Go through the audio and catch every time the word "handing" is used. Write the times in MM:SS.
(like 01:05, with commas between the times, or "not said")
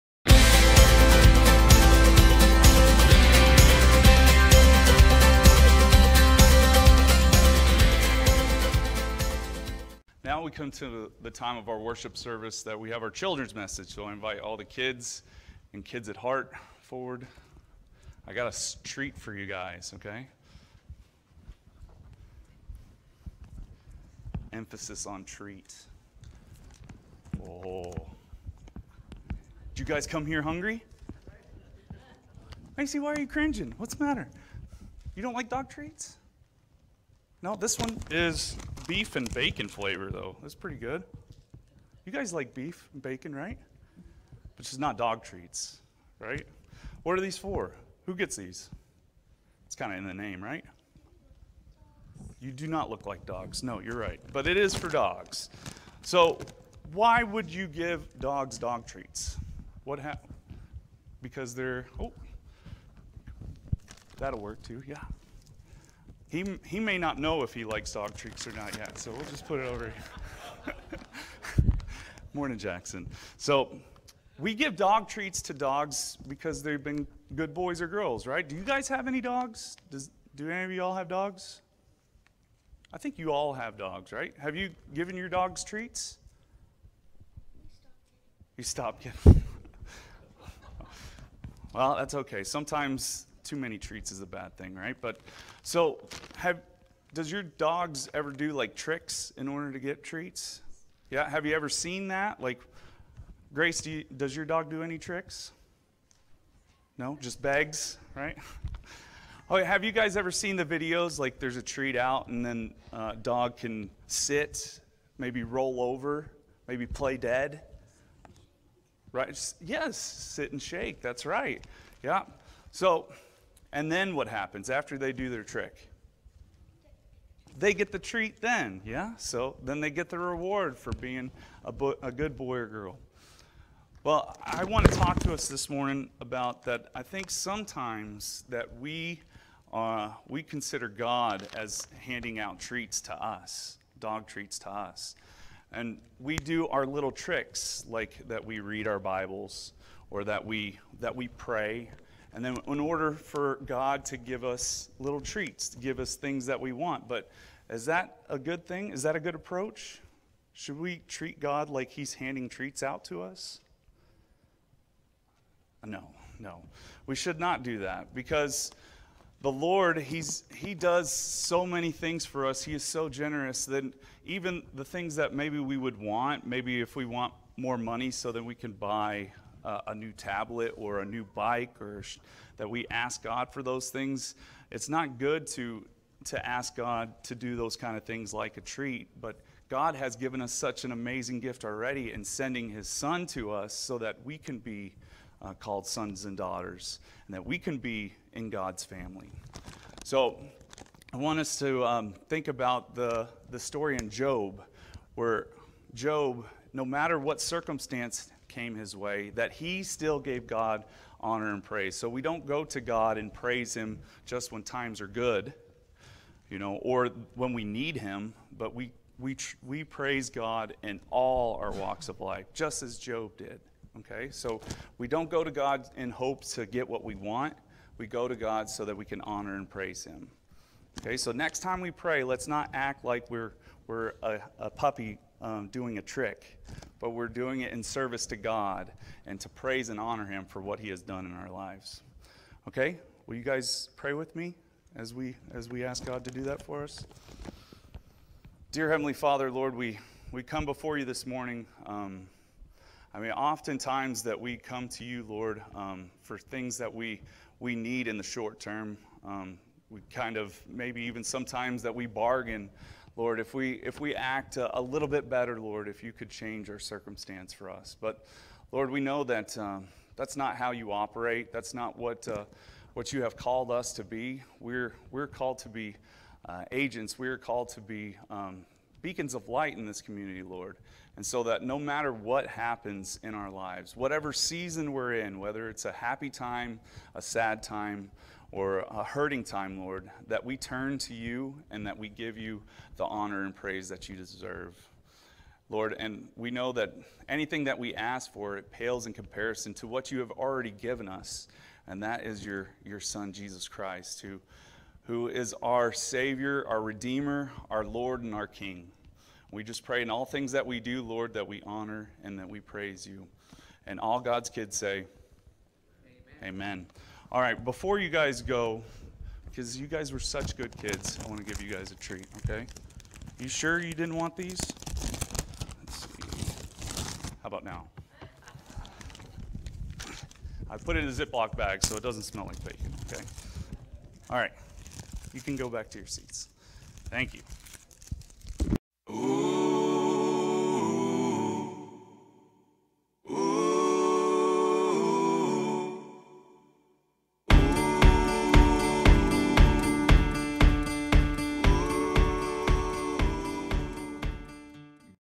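02:22, 02:42.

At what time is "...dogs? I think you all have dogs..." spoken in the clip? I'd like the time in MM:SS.
01:21.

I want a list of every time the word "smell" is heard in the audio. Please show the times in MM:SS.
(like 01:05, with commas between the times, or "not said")
05:32.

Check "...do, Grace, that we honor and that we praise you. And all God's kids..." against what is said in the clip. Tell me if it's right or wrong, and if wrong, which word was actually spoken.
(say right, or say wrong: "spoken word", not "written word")
wrong: "Lord", not "Grace".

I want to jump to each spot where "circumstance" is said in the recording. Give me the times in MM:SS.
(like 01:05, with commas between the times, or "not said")
03:27, 04:26.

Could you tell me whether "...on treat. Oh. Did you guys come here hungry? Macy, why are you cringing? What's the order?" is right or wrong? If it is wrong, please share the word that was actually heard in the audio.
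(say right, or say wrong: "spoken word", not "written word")
wrong: "matter", not "order".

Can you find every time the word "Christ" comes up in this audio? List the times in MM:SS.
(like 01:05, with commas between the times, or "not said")
05:03.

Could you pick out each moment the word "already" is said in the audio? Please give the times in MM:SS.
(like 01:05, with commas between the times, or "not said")
03:11, 05:00.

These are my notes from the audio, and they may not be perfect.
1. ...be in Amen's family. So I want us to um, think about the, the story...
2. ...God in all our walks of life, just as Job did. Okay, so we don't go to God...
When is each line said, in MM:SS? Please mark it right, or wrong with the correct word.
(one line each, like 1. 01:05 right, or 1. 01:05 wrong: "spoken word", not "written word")
1. 03:17 wrong: "God", not "Amen"
2. 03:40 right.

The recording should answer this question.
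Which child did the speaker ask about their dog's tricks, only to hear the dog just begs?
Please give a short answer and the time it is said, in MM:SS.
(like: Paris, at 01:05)
Grace, at 01:43.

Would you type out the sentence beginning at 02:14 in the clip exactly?
Well, I want to talk to us this morning about that.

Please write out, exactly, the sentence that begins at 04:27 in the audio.
But Lord, we know that um, that's not how you operate.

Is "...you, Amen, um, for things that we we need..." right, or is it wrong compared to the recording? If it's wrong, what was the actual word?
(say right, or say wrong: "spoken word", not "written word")
wrong: "Lord", not "Amen".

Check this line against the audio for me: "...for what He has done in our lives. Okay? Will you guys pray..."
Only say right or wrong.
right.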